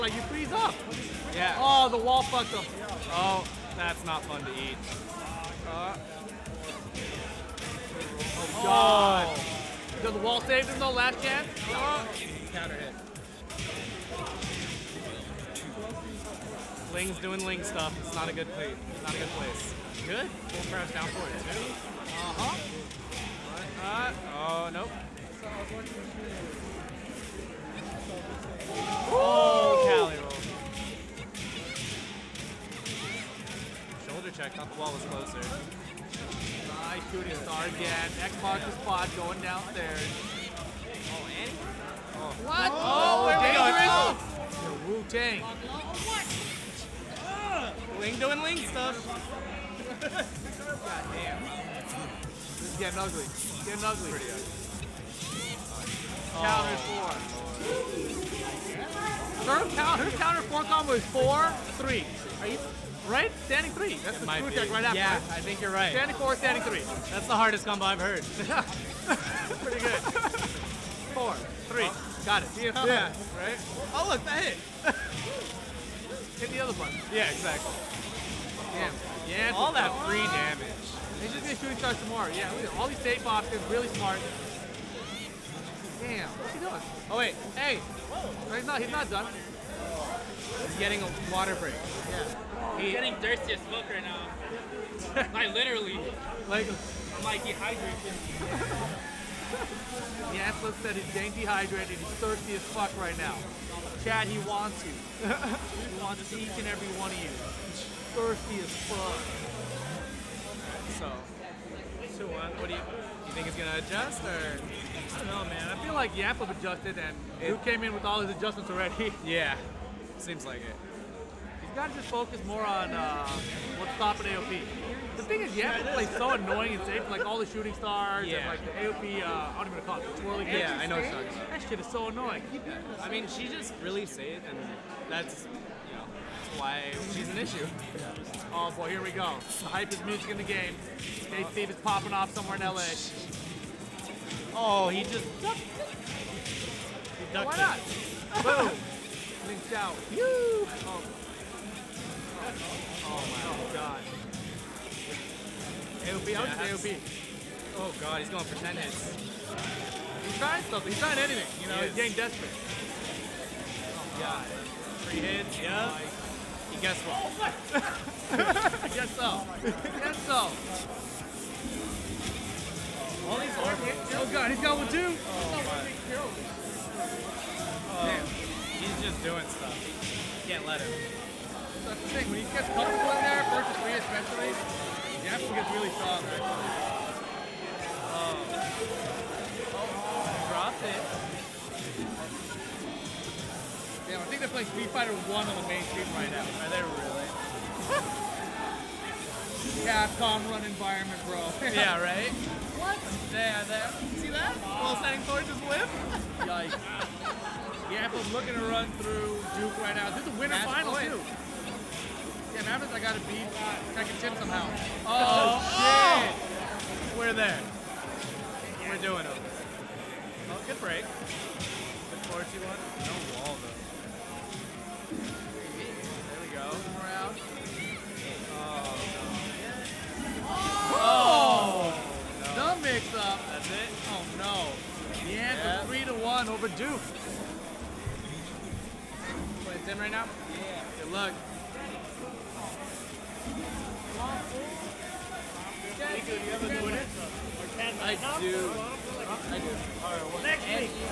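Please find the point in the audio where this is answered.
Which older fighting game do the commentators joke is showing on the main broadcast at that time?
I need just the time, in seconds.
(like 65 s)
194 s.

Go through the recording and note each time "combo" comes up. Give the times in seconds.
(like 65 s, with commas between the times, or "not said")
60 s, 67 s.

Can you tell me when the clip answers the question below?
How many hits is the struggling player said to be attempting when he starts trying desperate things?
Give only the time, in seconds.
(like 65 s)
158 s.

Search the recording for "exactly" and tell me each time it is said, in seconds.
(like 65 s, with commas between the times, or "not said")
77 s.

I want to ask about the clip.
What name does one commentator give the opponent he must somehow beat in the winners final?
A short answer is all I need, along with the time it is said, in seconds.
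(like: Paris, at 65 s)
Second Chip, at 213 s.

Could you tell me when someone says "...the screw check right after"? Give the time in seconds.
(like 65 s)
64 s.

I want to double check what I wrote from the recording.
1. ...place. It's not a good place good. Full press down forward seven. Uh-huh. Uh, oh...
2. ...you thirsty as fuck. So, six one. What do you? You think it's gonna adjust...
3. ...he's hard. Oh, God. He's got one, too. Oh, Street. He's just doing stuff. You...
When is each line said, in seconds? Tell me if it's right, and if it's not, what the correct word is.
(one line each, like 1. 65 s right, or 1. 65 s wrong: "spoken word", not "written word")
1. 18 s wrong: "two", not "seven"
2. 107 s wrong: "two", not "six"
3. 173 s wrong: "Damn", not "Street".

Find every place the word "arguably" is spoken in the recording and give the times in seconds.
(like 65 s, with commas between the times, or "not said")
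not said.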